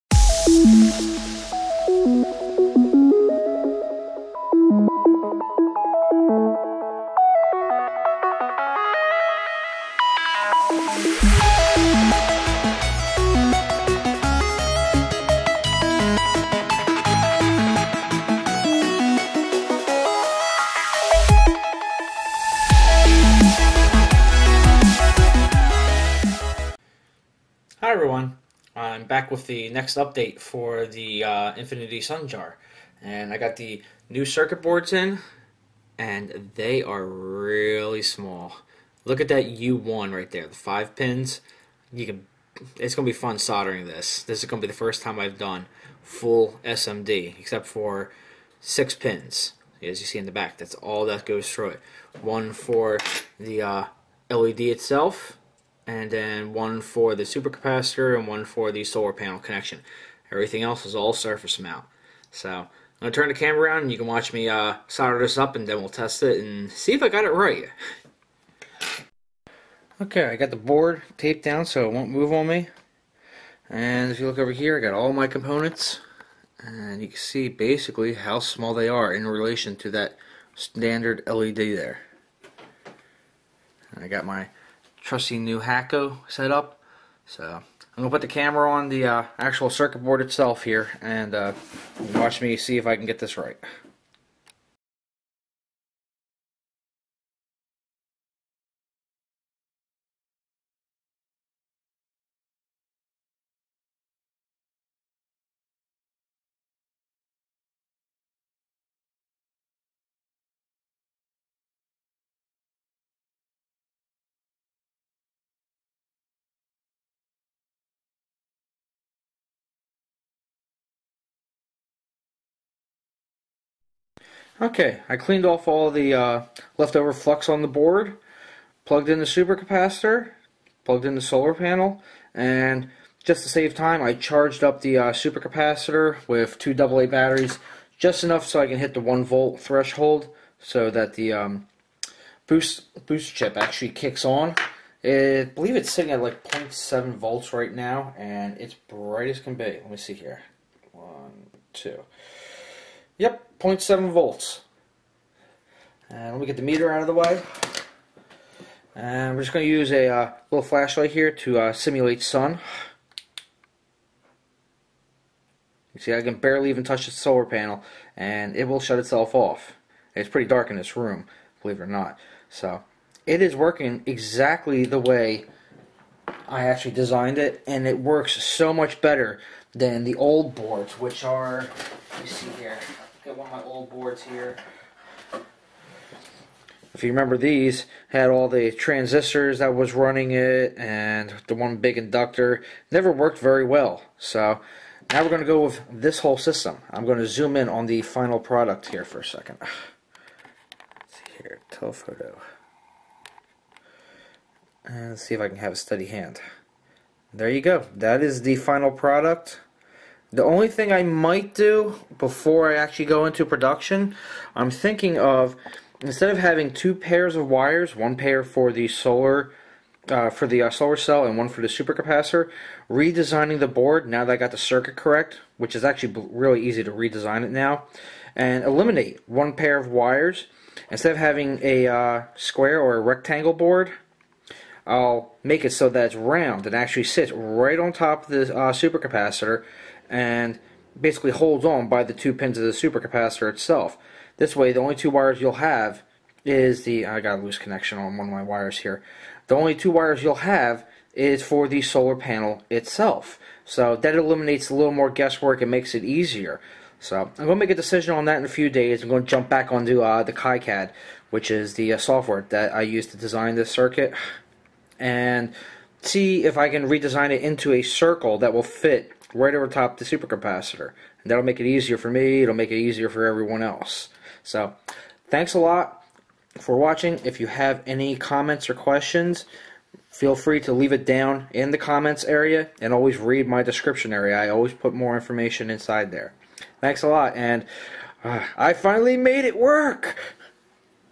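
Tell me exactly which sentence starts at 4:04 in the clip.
This way, the only two wires you'll have is the I got a loose connection on one of my wires here.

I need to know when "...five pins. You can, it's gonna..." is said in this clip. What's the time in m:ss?
0:40.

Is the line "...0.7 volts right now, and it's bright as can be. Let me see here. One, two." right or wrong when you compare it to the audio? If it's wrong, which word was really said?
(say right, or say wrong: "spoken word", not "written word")
right.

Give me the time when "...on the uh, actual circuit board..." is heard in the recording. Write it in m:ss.
1:28.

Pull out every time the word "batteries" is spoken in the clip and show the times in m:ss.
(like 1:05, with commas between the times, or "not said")
2:17.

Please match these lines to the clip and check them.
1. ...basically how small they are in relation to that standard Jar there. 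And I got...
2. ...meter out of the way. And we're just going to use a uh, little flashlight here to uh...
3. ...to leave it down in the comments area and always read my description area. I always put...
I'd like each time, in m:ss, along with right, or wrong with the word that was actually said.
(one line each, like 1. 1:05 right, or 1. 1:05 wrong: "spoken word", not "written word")
1. 1:17 wrong: "LED", not "Jar"
2. 2:36 right
3. 4:40 right.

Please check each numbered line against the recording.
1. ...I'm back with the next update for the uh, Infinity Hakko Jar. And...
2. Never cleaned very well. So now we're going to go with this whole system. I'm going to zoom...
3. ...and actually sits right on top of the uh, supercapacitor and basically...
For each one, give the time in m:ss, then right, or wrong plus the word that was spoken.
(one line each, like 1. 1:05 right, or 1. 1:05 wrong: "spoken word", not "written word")
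1. 0:28 wrong: "Sun", not "Hakko"
2. 3:12 wrong: "worked", not "cleaned"
3. 3:56 right.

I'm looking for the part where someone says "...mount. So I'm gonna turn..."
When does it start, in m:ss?
1:01.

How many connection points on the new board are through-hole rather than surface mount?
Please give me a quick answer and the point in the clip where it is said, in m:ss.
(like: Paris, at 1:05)
6, at 0:48.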